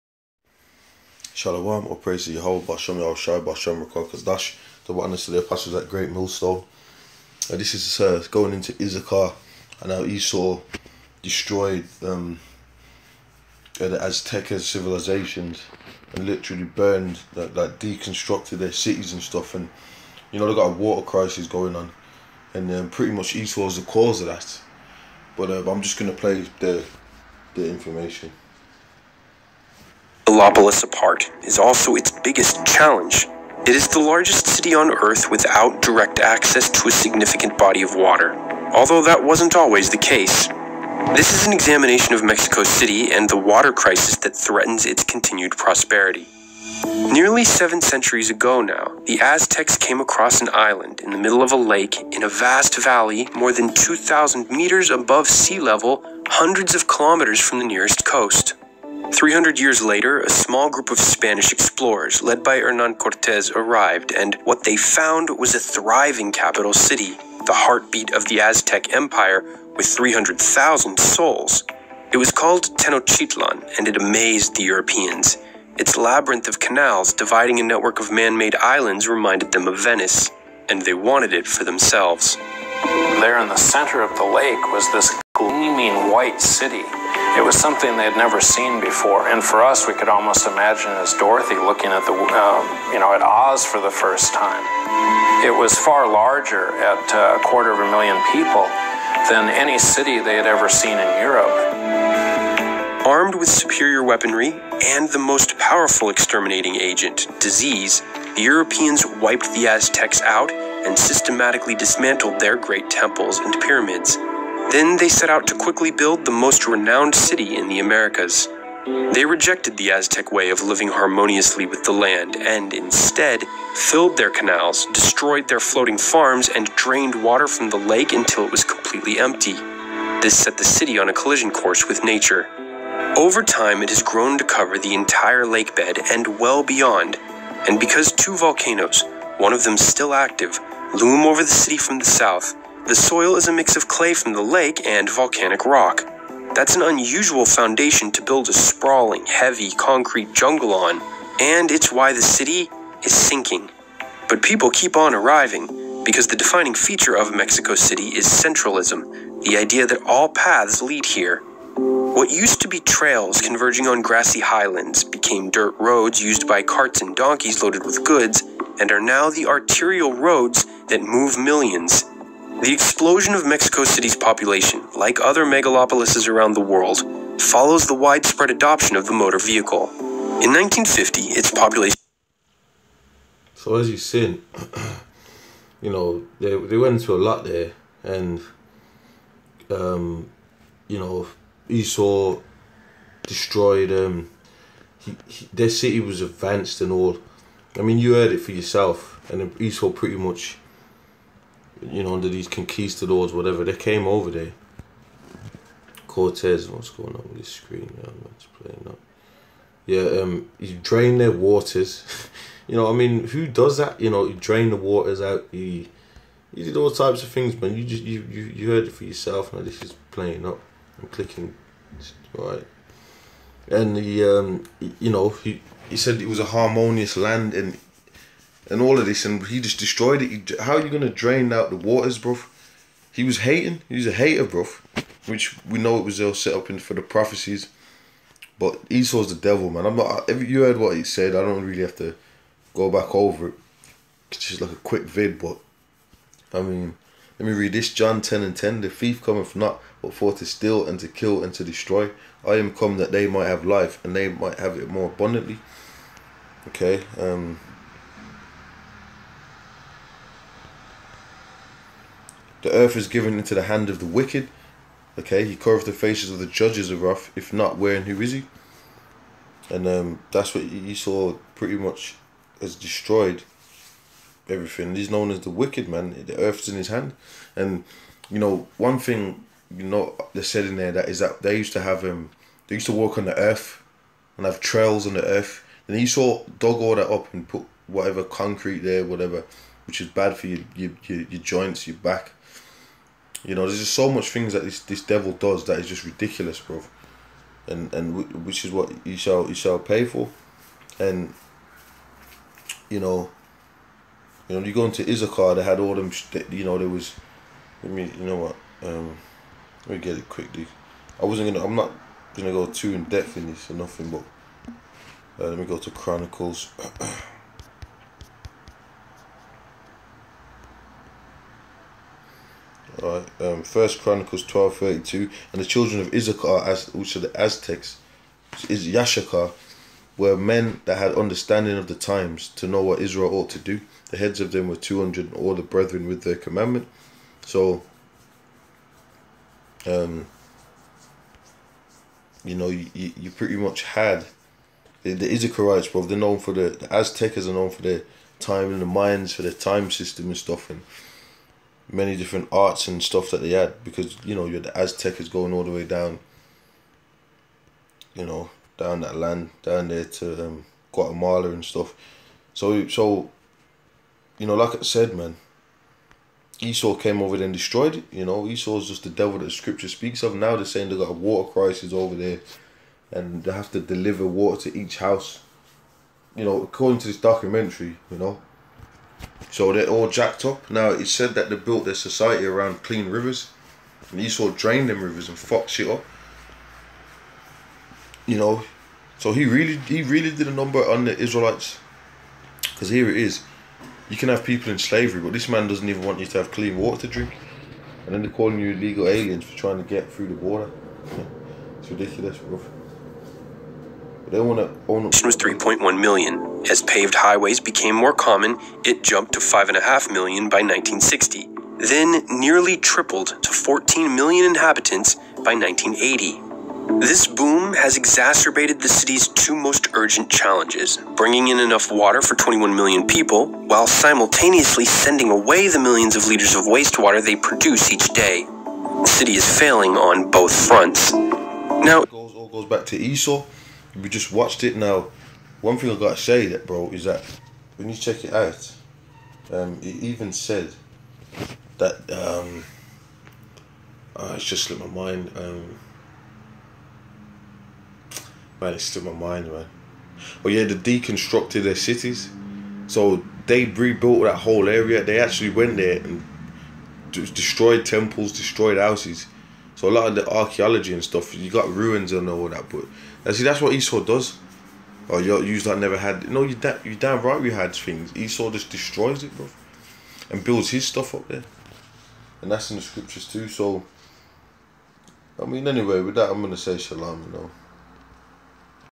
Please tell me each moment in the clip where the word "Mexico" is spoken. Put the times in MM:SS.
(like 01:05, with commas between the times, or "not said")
00:42, 02:37, 02:53.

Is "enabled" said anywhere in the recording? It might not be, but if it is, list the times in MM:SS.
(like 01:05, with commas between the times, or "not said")
not said.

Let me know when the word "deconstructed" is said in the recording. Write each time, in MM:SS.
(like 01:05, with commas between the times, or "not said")
00:17, 07:30.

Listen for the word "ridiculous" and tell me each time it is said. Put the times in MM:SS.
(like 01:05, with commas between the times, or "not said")
04:56, 06:41.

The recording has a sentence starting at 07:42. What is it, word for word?
But now see, that's what Esau does.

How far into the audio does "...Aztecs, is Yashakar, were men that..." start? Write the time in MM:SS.
05:27.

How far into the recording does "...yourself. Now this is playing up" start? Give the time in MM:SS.
03:39.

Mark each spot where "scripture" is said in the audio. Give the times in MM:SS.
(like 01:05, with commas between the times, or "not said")
06:09, 07:52.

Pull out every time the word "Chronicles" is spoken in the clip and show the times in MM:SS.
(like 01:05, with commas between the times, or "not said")
05:15, 05:24.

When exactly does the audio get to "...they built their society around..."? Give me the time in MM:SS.
06:21.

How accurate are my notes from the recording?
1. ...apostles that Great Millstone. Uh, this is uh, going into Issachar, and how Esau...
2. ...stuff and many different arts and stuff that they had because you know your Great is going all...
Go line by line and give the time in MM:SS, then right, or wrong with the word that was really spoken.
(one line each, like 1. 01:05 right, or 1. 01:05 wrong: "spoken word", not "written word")
1. 00:05 right
2. 05:50 wrong: "Aztec", not "Great".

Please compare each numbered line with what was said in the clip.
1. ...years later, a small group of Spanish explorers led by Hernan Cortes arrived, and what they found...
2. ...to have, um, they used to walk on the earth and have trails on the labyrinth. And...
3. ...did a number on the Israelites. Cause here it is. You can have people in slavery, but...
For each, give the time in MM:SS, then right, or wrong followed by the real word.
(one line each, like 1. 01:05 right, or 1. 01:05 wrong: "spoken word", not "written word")
1. 00:59 right
2. 04:41 wrong: "earth", not "labyrinth"
3. 06:30 right.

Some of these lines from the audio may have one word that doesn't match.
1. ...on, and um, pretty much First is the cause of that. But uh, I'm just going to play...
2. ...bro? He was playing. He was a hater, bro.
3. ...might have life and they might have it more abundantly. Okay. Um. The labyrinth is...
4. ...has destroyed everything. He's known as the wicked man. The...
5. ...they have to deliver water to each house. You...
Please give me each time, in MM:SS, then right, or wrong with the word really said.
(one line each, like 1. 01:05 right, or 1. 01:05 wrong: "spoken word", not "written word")
1. 00:21 wrong: "Esau", not "First"
2. 03:52 wrong: "hating", not "playing"
3. 04:13 wrong: "earth", not "labyrinth"
4. 04:32 right
5. 06:13 right.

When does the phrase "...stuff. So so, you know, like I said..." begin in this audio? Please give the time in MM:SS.
06:01.